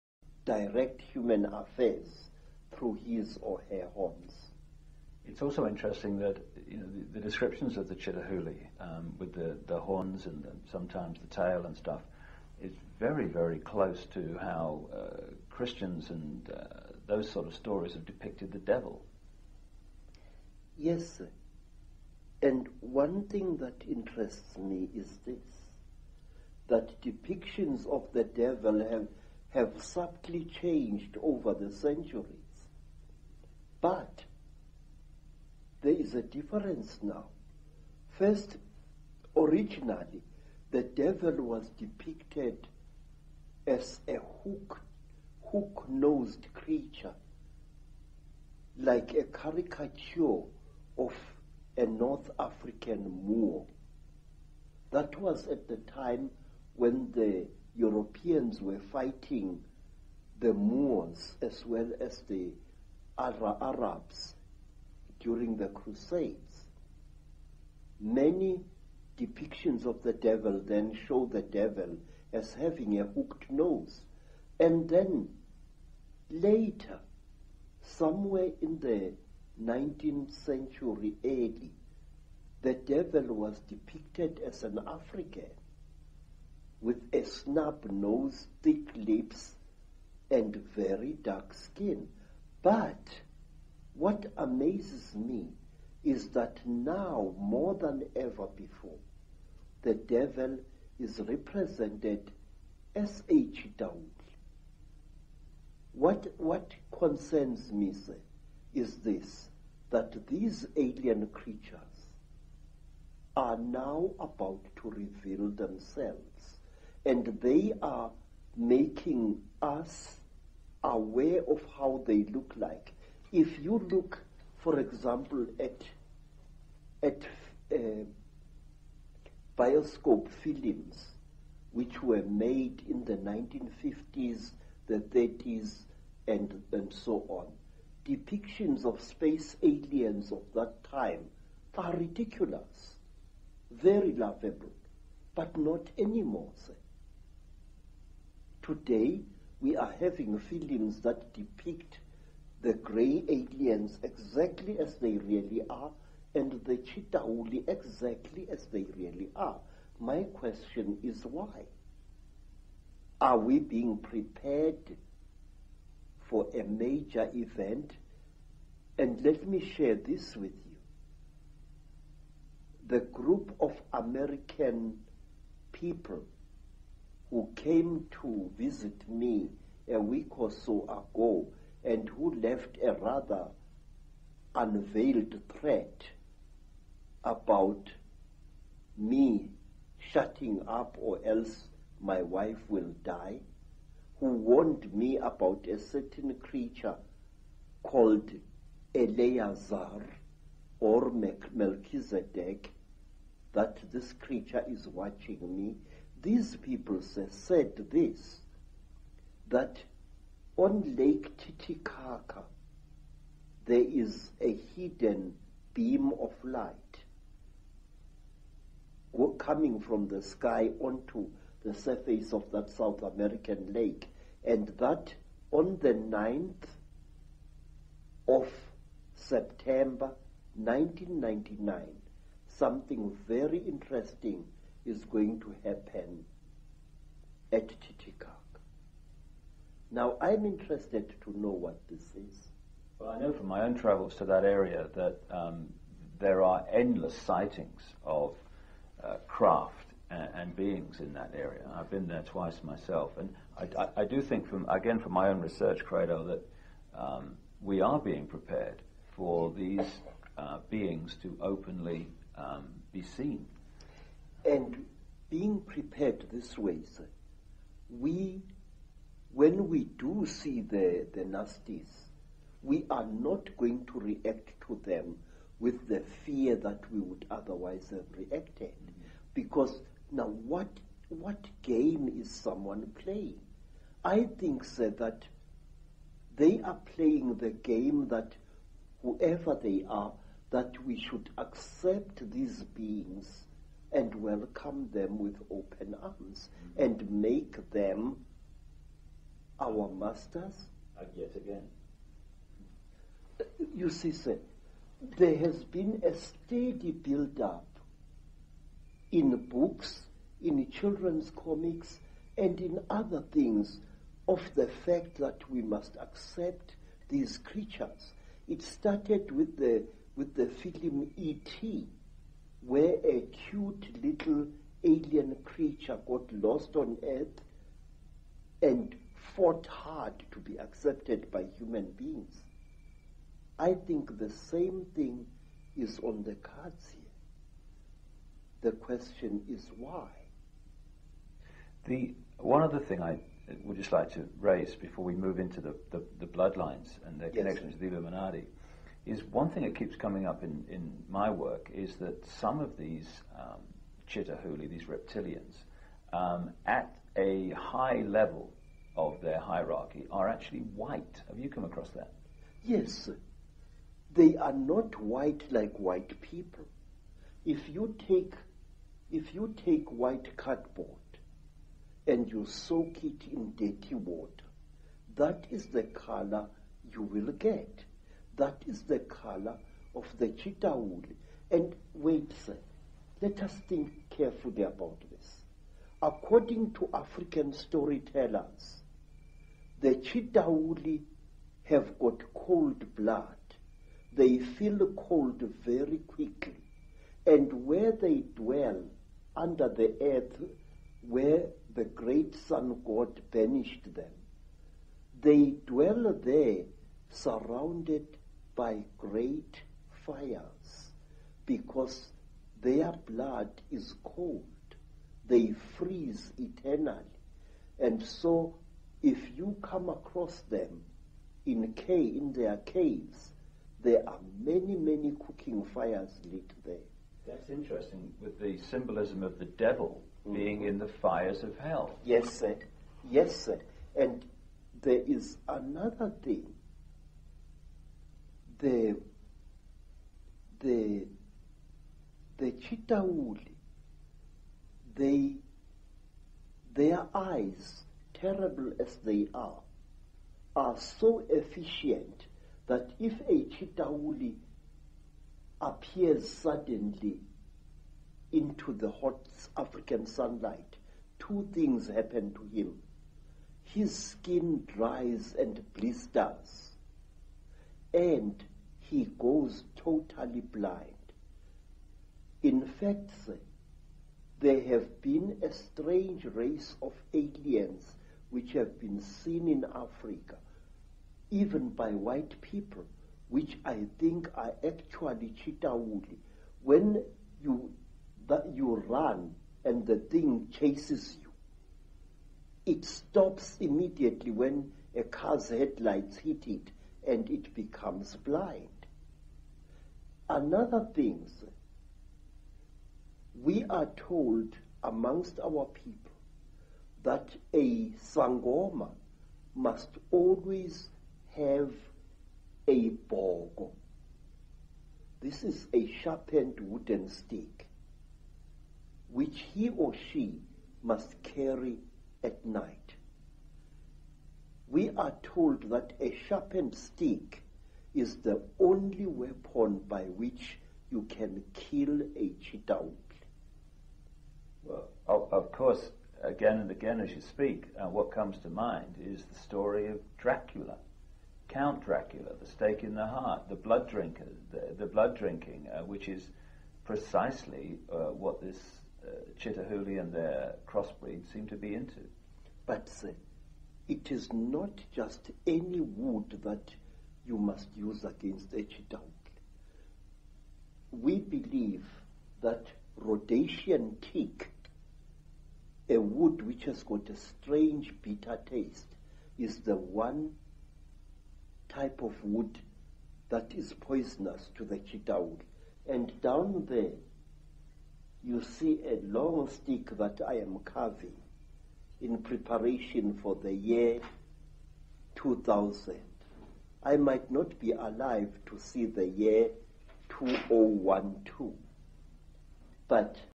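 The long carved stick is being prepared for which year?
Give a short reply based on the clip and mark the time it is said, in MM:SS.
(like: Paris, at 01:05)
2000, at 09:43.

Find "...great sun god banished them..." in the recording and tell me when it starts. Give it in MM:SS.
06:41.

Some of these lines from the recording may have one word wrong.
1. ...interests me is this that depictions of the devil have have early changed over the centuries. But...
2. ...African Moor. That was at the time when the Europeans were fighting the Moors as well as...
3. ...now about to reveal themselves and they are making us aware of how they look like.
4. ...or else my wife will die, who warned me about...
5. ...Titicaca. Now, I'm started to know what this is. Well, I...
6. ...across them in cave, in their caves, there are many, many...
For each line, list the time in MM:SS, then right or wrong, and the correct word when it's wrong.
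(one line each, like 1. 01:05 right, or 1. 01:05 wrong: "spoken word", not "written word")
1. 00:23 wrong: "subtly", not "early"
2. 00:52 right
3. 01:53 right
4. 03:10 right
5. 03:57 wrong: "interested", not "started"
6. 06:59 right.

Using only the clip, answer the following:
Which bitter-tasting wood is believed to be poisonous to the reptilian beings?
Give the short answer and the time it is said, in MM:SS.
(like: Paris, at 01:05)
Rhodesian teak, at 09:22.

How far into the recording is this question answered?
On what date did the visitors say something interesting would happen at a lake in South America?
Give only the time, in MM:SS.
03:45.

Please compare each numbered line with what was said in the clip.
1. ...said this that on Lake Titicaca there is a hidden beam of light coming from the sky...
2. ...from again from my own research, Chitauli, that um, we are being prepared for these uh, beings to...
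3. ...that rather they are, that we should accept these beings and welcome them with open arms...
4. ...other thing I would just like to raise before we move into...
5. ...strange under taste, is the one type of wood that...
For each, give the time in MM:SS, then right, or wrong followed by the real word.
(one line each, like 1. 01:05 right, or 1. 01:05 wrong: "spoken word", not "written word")
1. 03:27 right
2. 04:14 wrong: "Credo", not "Chitauli"
3. 04:48 wrong: "whoever", not "rather"
4. 05:42 right
5. 09:27 wrong: "bitter", not "under".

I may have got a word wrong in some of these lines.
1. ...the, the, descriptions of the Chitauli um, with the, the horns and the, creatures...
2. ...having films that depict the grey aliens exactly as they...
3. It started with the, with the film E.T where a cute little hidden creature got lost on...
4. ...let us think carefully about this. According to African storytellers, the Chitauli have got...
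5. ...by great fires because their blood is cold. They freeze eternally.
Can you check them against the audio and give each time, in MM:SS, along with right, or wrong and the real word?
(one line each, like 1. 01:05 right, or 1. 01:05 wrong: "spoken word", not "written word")
1. 00:06 wrong: "sometimes", not "creatures"
2. 02:29 right
3. 05:18 wrong: "alien", not "hidden"
4. 06:23 right
5. 06:48 right.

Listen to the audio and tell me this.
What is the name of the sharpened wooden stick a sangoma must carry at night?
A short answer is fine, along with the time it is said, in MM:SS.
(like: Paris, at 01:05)
bogo, at 08:33.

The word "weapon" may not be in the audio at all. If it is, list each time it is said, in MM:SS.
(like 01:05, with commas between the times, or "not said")
08:49.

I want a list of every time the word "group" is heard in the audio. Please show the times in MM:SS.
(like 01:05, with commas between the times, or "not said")
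02:52.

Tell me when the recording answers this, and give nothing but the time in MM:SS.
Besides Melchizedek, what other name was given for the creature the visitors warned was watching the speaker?
03:18.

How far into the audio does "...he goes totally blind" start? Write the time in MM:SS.
07:48.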